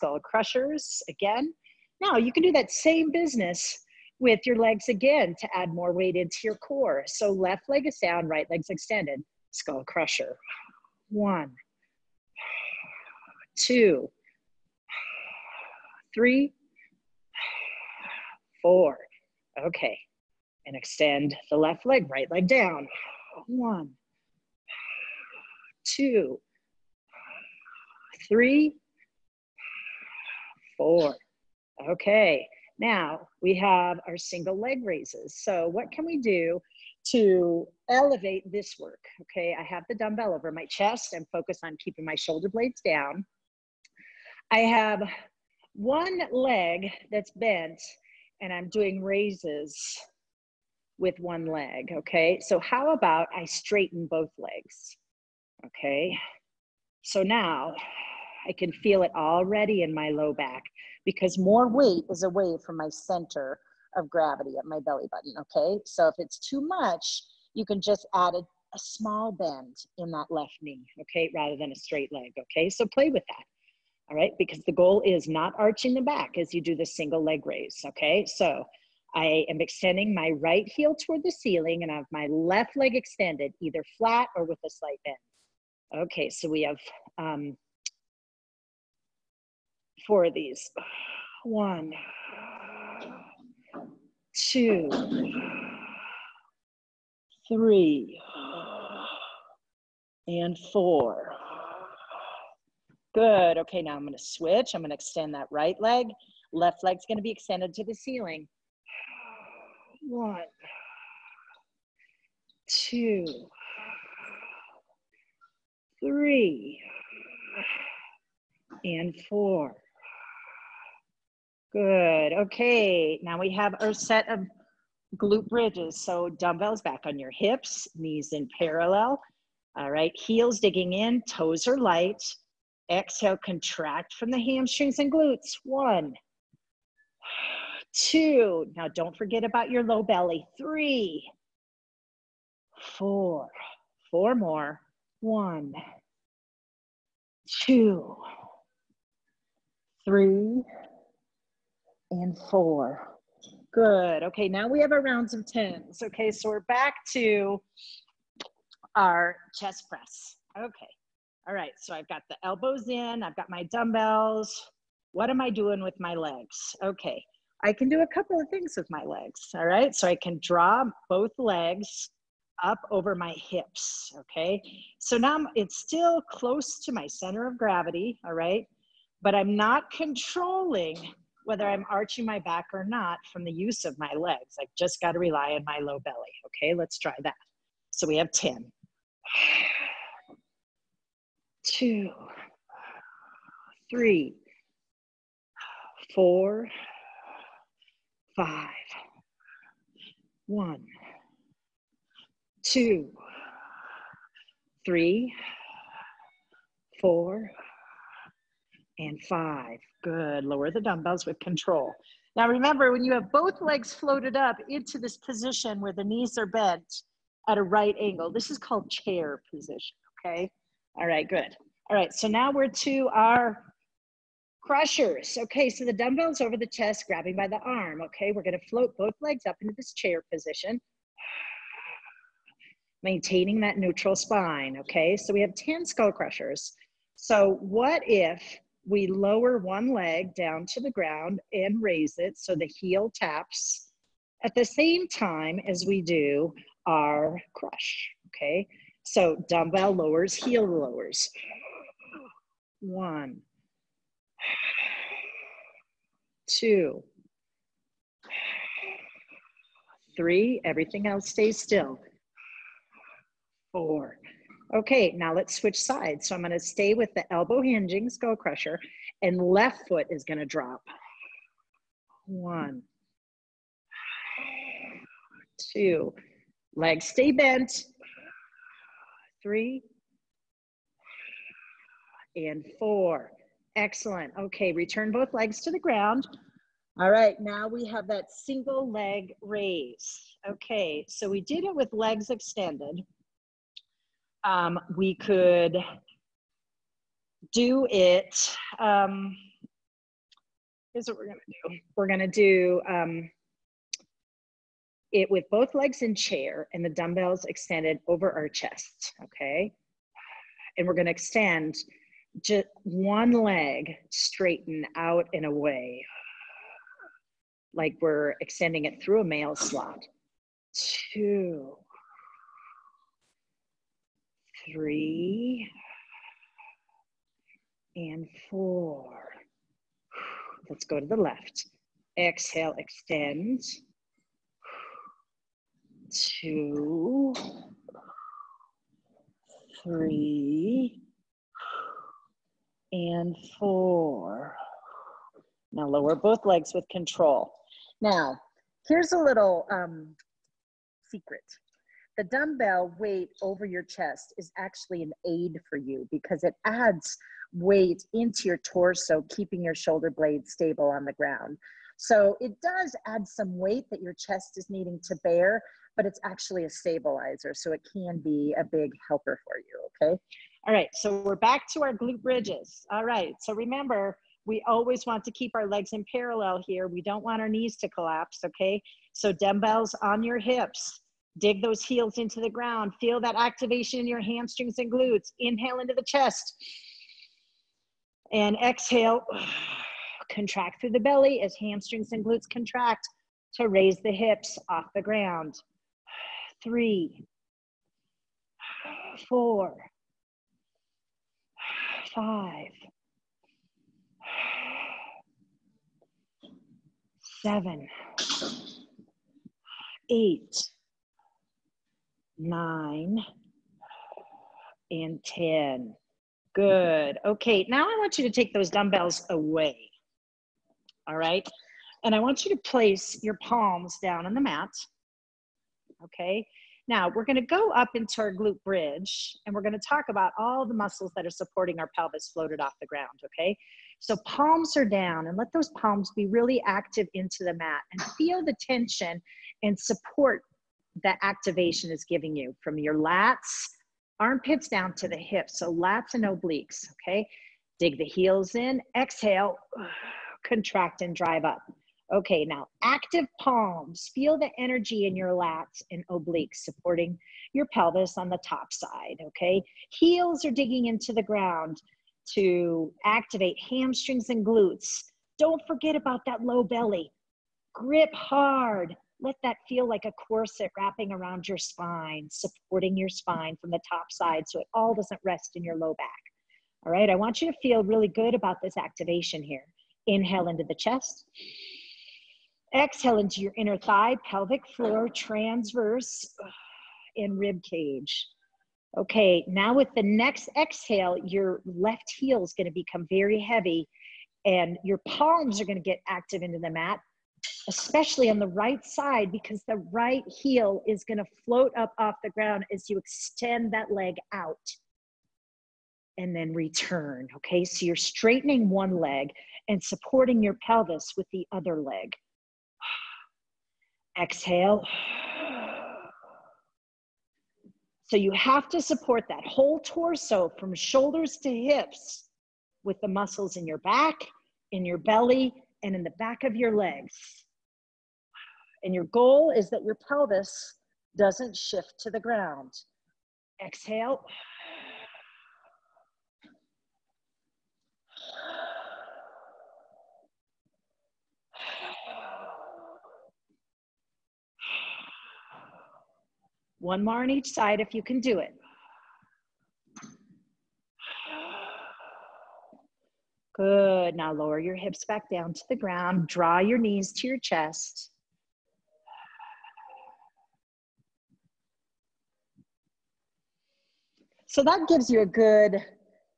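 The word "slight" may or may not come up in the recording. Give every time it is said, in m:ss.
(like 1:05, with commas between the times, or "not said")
1:24.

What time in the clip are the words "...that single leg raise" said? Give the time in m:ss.
4:48.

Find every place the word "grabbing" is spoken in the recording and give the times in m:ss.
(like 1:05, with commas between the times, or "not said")
3:47.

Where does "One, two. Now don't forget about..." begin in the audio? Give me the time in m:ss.
2:15.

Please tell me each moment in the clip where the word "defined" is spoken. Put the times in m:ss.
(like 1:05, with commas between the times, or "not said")
not said.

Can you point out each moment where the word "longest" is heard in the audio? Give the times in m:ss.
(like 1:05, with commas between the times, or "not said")
not said.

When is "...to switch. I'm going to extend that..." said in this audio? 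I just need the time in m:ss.
1:44.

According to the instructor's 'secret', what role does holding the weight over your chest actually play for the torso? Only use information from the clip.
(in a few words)
a stabilizer.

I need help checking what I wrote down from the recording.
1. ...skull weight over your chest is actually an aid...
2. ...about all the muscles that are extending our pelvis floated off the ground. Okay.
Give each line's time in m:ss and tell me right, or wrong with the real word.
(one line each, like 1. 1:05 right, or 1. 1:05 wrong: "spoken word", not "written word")
1. 5:52 wrong: "dumbbell", not "skull"
2. 7:10 wrong: "supporting", not "extending".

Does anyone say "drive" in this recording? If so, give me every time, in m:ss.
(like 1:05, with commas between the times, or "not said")
7:31.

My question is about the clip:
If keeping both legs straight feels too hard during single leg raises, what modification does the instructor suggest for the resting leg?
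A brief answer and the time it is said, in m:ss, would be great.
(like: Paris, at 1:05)
a small bend, at 1:08.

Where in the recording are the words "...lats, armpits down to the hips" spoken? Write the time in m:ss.
7:22.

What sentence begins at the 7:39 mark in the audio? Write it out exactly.
Heels are digging into the ground to activate hamstrings and glutes.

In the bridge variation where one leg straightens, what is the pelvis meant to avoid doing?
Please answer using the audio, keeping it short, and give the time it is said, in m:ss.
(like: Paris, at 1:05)
shift to the ground, at 8:51.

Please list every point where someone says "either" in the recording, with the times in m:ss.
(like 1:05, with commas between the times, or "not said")
1:23.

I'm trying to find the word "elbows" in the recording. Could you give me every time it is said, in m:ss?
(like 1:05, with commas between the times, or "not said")
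2:42, 4:27.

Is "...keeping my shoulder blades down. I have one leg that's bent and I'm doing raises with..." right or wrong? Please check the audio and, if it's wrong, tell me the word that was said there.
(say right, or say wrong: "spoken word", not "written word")
right.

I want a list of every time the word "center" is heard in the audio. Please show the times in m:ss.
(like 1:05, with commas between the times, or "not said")
1:02, 2:57.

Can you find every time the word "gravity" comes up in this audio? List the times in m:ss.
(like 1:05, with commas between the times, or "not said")
1:04, 2:57.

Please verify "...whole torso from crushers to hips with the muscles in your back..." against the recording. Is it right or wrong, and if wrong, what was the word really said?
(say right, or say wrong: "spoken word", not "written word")
wrong: "shoulders", not "crushers".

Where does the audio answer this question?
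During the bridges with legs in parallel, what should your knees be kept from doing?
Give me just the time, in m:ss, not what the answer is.
6:17.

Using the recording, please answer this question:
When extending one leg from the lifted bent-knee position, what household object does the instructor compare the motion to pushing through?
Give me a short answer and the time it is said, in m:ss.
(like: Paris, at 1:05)
a mail slot, at 5:19.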